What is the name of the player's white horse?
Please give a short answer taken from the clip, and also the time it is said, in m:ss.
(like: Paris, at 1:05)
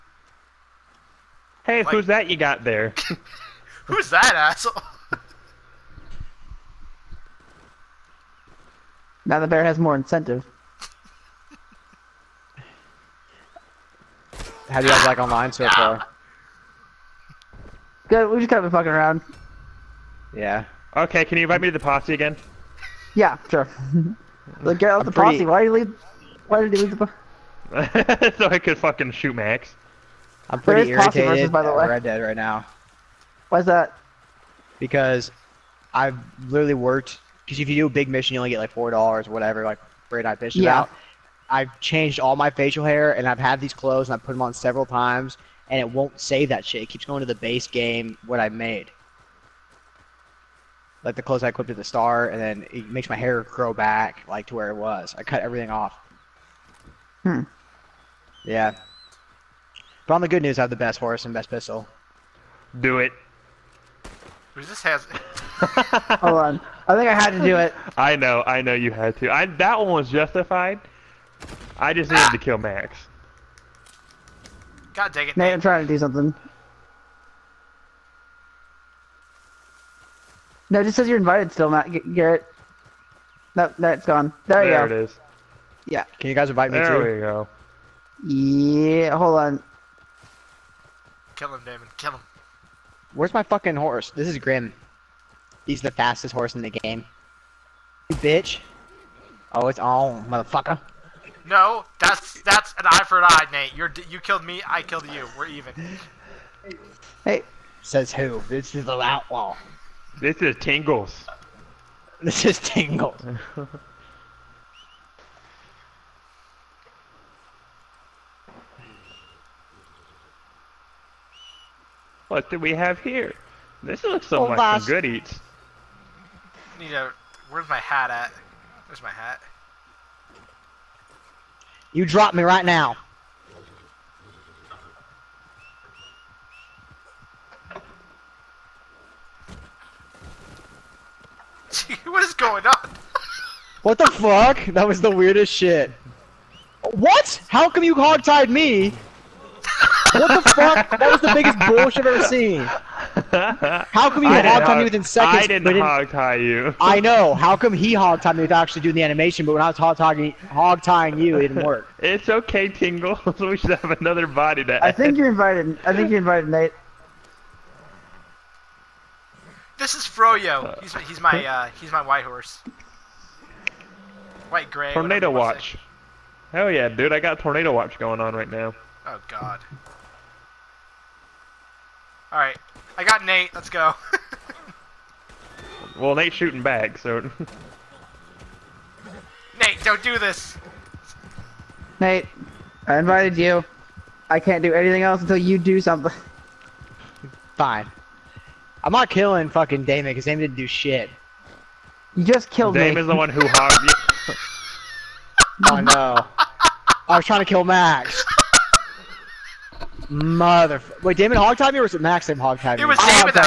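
Froyo, at 2:50.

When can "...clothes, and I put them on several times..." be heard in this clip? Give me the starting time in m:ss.
0:43.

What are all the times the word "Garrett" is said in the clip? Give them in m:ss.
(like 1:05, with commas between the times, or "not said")
1:22.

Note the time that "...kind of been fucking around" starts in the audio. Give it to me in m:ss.
0:18.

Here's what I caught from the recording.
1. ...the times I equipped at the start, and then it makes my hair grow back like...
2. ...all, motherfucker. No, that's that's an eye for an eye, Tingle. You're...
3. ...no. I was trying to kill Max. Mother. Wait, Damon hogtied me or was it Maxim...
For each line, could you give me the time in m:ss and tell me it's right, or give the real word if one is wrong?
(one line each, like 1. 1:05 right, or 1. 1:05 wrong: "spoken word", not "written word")
1. 0:51 wrong: "clothes", not "times"
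2. 1:39 wrong: "Nate", not "Tingle"
3. 3:25 right.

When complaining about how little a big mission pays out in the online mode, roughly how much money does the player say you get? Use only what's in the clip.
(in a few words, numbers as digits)
$4.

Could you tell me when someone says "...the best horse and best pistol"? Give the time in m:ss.
1:00.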